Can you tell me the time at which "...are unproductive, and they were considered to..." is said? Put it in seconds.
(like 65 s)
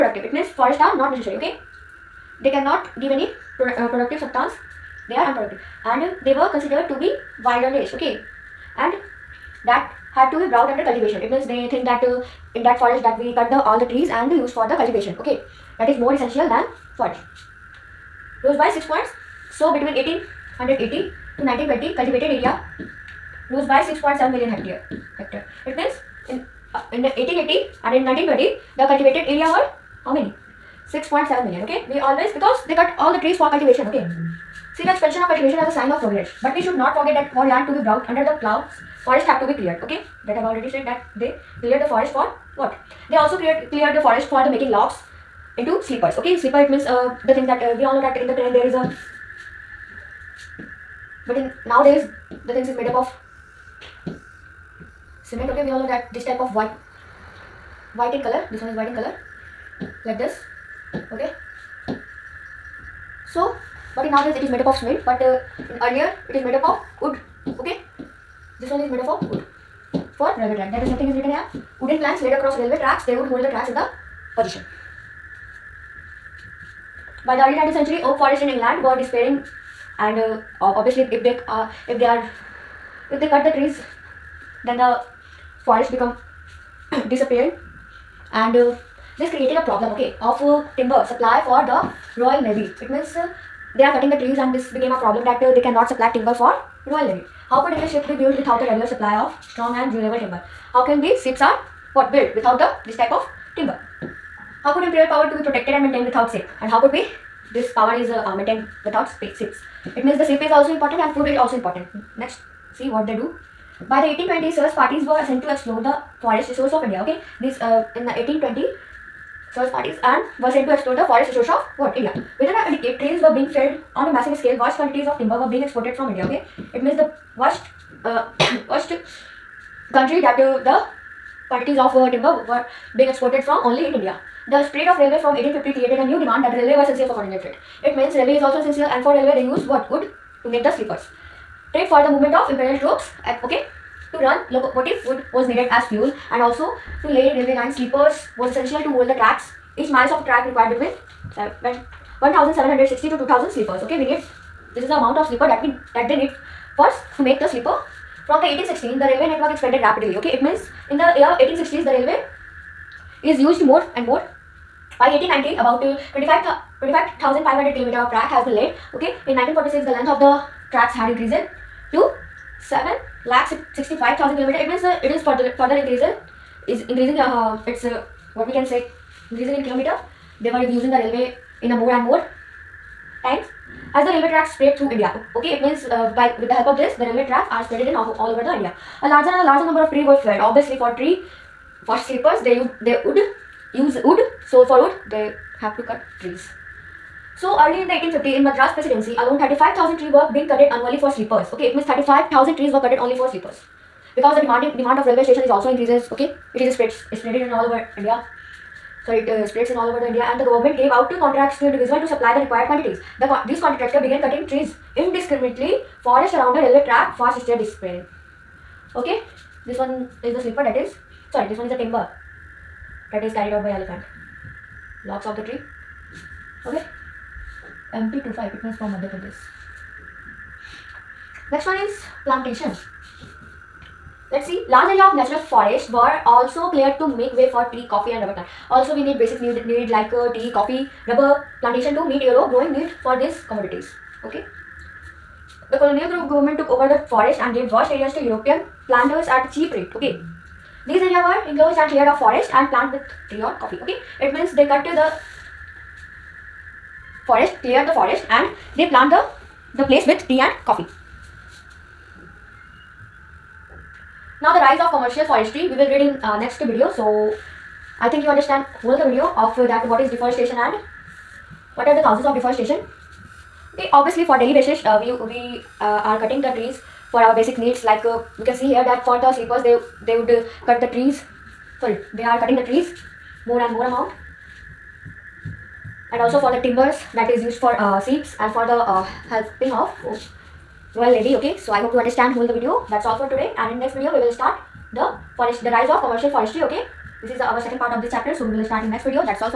5 s.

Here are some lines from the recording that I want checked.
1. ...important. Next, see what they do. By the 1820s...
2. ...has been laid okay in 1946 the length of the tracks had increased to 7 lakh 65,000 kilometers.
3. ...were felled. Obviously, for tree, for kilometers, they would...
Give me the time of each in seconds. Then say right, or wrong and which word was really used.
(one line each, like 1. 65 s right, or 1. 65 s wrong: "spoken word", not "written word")
1. 111 s right
2. 168 s right
3. 190 s wrong: "sleepers", not "kilometers".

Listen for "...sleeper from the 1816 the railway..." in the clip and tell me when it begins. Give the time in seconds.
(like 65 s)
157 s.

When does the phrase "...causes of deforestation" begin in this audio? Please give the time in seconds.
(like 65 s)
272 s.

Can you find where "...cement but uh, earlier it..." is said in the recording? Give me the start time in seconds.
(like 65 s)
64 s.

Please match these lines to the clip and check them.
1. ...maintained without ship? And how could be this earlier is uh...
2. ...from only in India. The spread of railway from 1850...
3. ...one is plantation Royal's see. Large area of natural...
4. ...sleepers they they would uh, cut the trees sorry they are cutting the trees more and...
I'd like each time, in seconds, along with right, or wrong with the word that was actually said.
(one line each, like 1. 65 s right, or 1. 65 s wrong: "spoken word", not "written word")
1. 105 s wrong: "power", not "earlier"
2. 133 s right
3. 231 s wrong: "Let", not "Royal"
4. 279 s right.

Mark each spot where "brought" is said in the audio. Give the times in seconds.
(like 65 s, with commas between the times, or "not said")
10 s, 37 s.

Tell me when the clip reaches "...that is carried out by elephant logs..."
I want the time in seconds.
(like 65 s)
223 s.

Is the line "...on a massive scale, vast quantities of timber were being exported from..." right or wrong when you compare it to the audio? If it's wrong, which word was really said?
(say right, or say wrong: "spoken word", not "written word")
right.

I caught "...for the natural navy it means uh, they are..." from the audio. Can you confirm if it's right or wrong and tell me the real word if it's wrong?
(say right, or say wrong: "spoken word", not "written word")
wrong: "royal", not "natural".